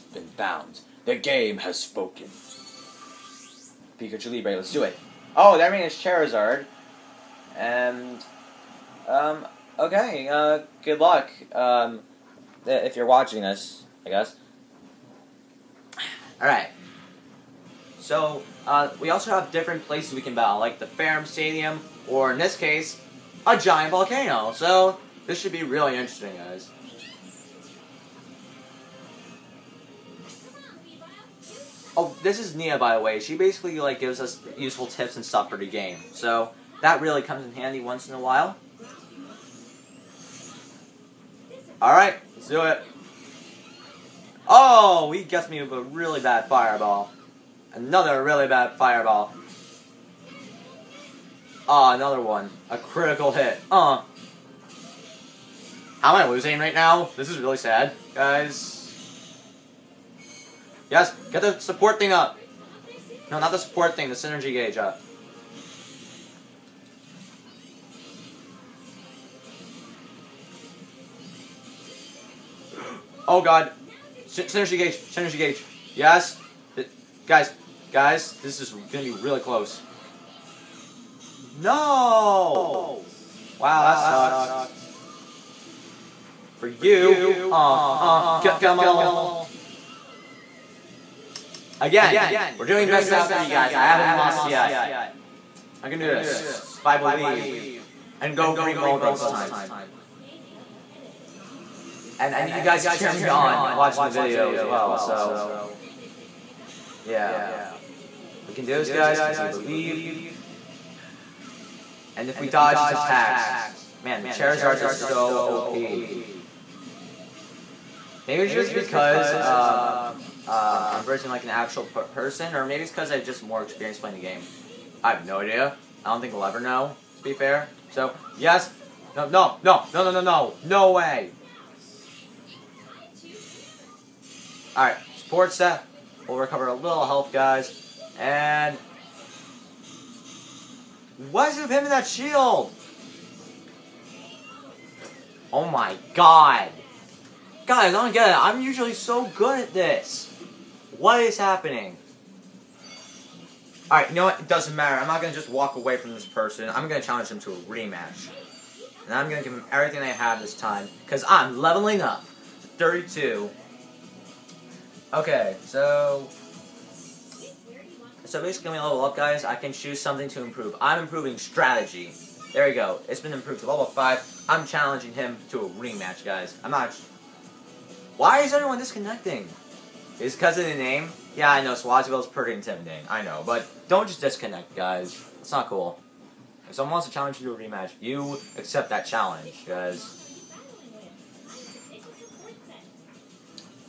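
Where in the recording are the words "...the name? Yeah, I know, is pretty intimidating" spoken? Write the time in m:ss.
3:00.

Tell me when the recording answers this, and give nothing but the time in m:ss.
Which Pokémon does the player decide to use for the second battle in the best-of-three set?
1:38.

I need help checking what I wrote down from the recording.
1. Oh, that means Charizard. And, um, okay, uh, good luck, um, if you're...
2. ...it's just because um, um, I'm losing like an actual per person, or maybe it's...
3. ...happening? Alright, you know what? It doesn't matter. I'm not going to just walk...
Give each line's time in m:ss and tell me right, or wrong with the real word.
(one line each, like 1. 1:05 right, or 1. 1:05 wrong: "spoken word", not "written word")
1. 0:05 right
2. 1:58 wrong: "versing", not "losing"
3. 2:31 right.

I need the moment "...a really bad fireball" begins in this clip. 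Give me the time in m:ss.
0:45.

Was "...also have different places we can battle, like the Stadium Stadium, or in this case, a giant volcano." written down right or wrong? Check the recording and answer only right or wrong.
wrong.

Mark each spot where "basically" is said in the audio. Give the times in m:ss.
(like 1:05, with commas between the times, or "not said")
0:33, 2:48.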